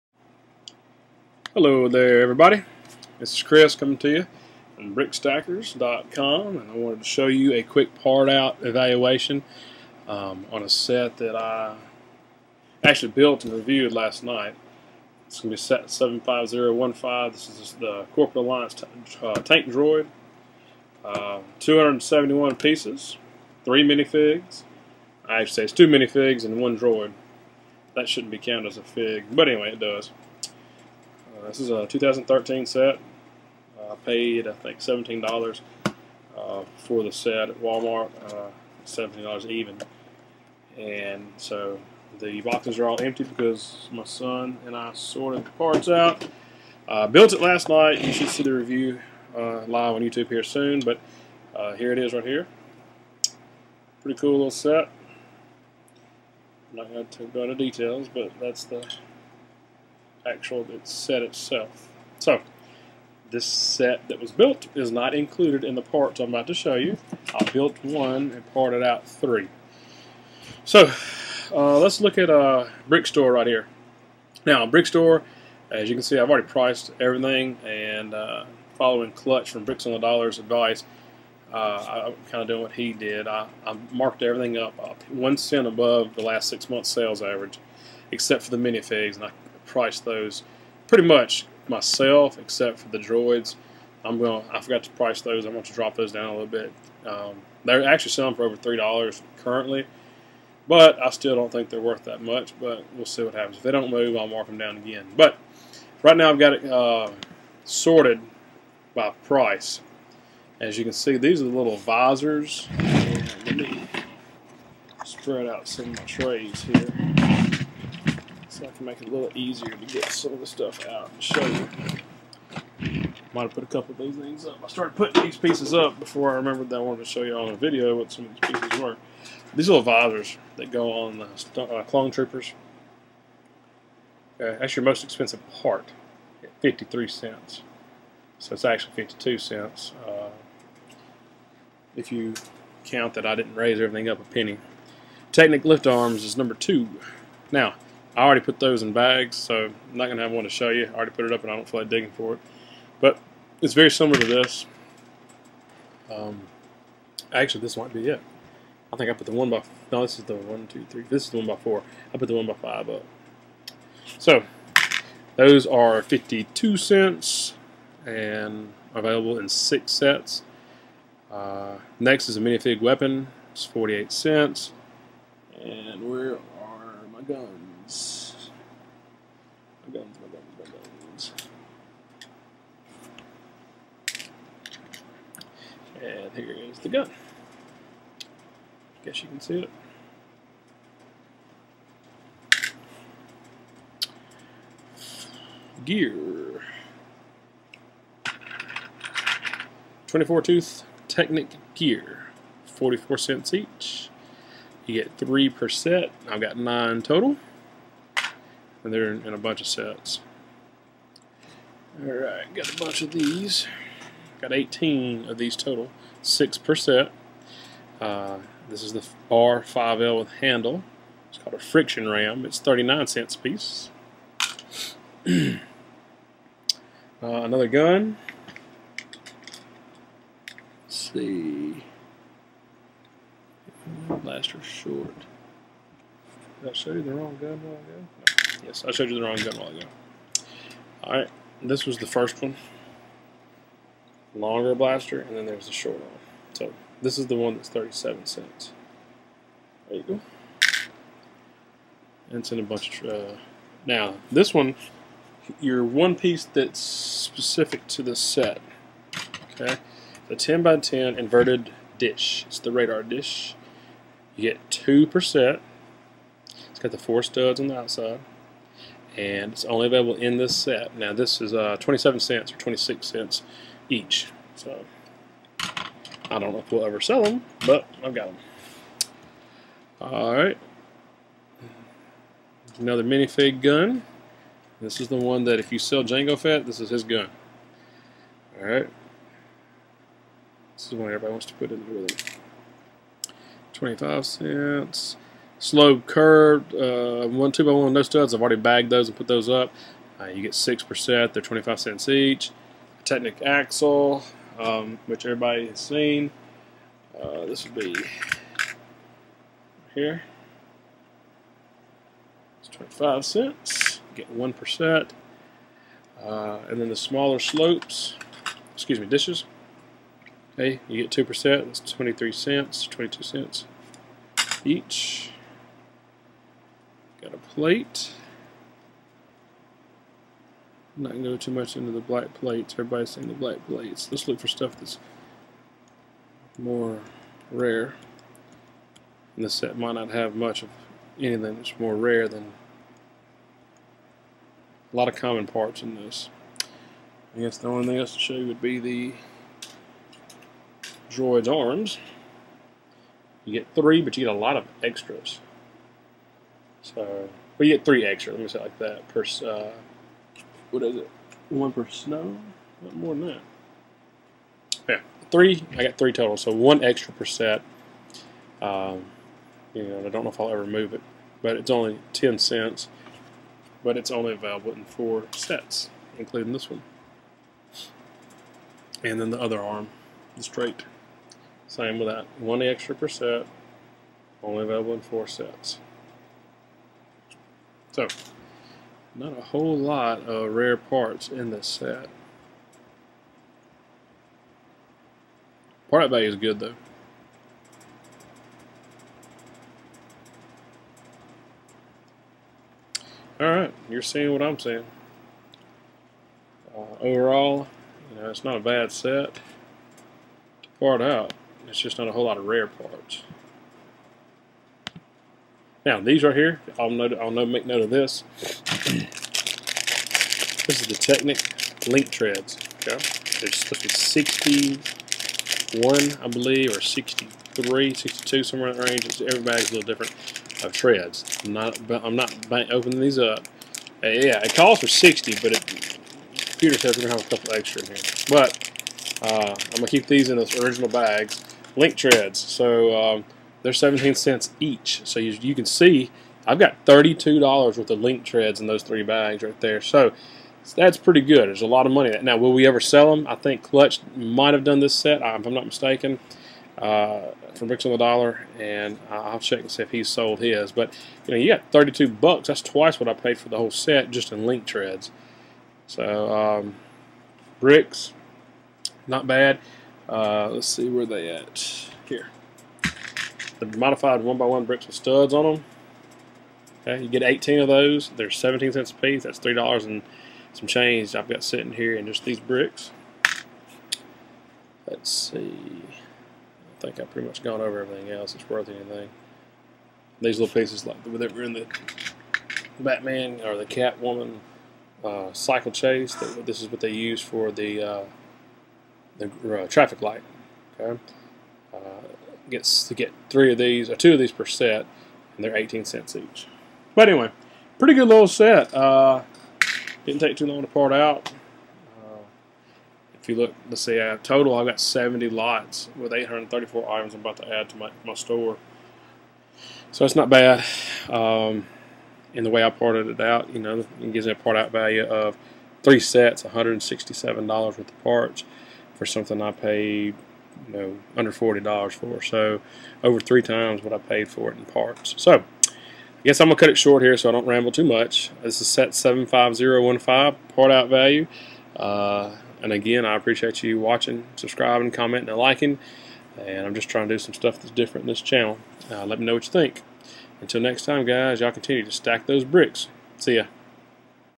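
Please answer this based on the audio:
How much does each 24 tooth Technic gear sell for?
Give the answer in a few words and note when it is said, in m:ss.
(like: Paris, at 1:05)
44 cents, at 3:22.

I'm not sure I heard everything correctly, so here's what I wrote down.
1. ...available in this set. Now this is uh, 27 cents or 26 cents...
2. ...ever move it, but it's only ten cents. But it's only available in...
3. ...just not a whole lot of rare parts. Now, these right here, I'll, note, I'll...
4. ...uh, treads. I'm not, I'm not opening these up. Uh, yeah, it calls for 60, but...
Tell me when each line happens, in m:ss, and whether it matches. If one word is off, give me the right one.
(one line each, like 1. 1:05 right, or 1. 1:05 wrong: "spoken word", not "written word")
1. 4:29 right
2. 6:10 right
3. 6:51 right
4. 7:10 right.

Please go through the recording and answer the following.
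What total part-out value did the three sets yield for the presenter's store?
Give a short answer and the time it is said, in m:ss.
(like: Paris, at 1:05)
$167, at 8:46.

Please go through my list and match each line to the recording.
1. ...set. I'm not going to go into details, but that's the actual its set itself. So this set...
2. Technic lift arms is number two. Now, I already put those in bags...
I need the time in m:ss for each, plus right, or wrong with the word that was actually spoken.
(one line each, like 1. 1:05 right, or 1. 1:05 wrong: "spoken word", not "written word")
1. 0:54 right
2. 2:25 right.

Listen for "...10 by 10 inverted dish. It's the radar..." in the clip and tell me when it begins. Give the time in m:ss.
4:20.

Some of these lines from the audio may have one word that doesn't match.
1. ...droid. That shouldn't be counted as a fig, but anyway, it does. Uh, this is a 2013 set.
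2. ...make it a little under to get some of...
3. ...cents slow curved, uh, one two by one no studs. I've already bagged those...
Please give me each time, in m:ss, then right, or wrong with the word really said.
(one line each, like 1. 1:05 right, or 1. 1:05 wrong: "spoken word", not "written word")
1. 0:26 right
2. 1:58 wrong: "easier", not "under"
3. 4:54 right.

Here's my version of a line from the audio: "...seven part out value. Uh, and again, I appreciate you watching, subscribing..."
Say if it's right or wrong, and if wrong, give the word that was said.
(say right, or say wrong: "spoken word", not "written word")
wrong: "five", not "seven".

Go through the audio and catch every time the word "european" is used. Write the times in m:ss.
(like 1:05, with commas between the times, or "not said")
not said.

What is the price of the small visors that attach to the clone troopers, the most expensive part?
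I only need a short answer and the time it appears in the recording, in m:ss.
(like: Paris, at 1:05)
53 cents, at 2:16.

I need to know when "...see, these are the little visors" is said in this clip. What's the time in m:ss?
1:50.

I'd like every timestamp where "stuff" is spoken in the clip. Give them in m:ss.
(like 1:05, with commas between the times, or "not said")
2:00, 5:34, 9:07.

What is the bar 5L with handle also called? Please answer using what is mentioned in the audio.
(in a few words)
friction ram.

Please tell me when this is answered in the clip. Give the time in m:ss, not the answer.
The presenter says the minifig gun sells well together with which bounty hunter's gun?
4:46.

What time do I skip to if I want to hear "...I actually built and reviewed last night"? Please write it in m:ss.
0:11.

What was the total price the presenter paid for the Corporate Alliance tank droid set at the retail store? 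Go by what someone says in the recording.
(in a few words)
$17.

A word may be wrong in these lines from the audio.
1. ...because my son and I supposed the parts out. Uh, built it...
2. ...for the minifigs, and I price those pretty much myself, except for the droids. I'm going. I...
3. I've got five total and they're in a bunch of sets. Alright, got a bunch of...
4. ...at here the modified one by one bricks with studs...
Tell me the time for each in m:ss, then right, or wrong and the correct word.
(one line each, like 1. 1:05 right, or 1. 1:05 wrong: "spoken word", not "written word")
1. 0:43 wrong: "sorted", not "supposed"
2. 1:28 right
3. 3:26 wrong: "nine", not "five"
4. 7:51 right.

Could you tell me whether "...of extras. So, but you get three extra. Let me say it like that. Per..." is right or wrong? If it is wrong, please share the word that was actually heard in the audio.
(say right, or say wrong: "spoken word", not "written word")
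right.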